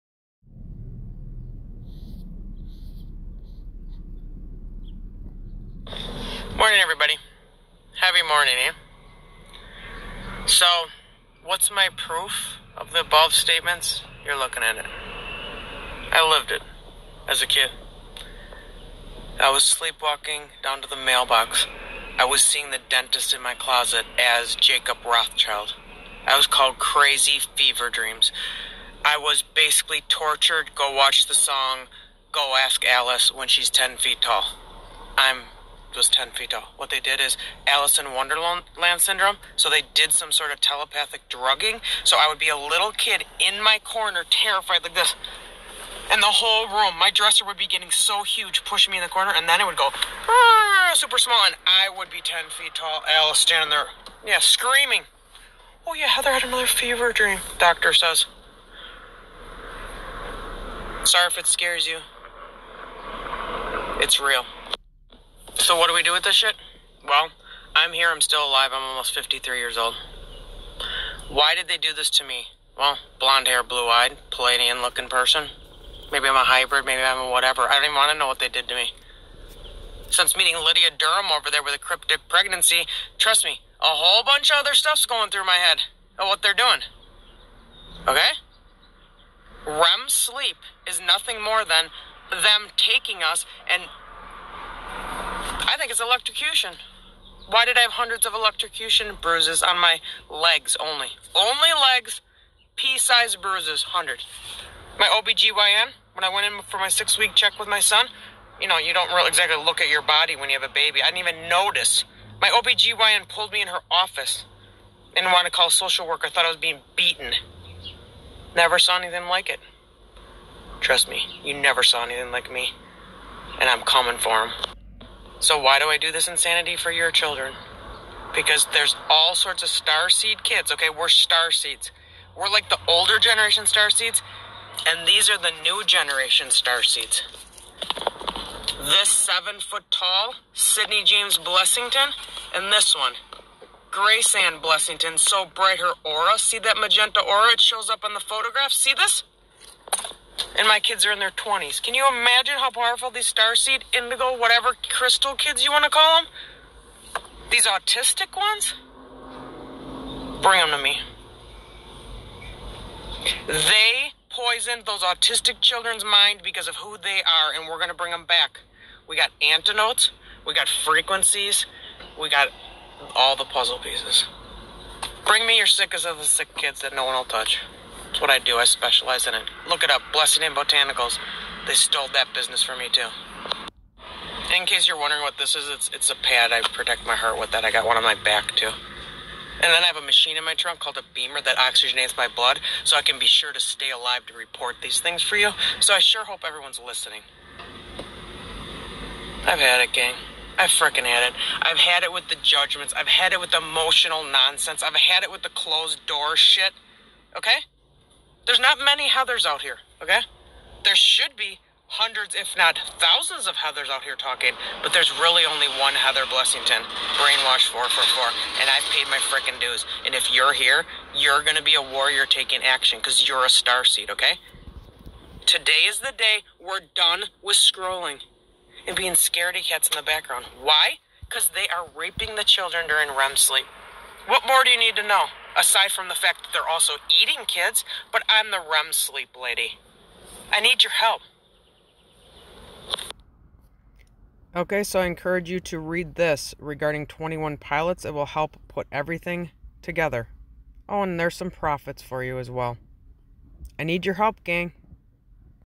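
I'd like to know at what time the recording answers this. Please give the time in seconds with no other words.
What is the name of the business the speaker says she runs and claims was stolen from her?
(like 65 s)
180 s.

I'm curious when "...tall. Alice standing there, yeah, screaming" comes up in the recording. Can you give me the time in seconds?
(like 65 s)
52 s.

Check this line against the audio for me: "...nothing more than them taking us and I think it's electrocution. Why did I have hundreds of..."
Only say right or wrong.
right.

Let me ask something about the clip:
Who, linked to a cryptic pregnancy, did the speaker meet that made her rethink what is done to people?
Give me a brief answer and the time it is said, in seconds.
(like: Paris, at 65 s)
Lydia Durham, at 80 s.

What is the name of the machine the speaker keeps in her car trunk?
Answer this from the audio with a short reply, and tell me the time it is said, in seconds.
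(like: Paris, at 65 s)
BEMER, at 191 s.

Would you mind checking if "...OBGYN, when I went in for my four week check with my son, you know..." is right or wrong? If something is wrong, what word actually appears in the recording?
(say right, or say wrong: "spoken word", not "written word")
wrong: "six", not "four".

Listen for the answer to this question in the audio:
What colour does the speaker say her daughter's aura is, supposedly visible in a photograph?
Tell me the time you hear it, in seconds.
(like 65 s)
146 s.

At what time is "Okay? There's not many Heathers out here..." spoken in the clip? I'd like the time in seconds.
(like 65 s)
207 s.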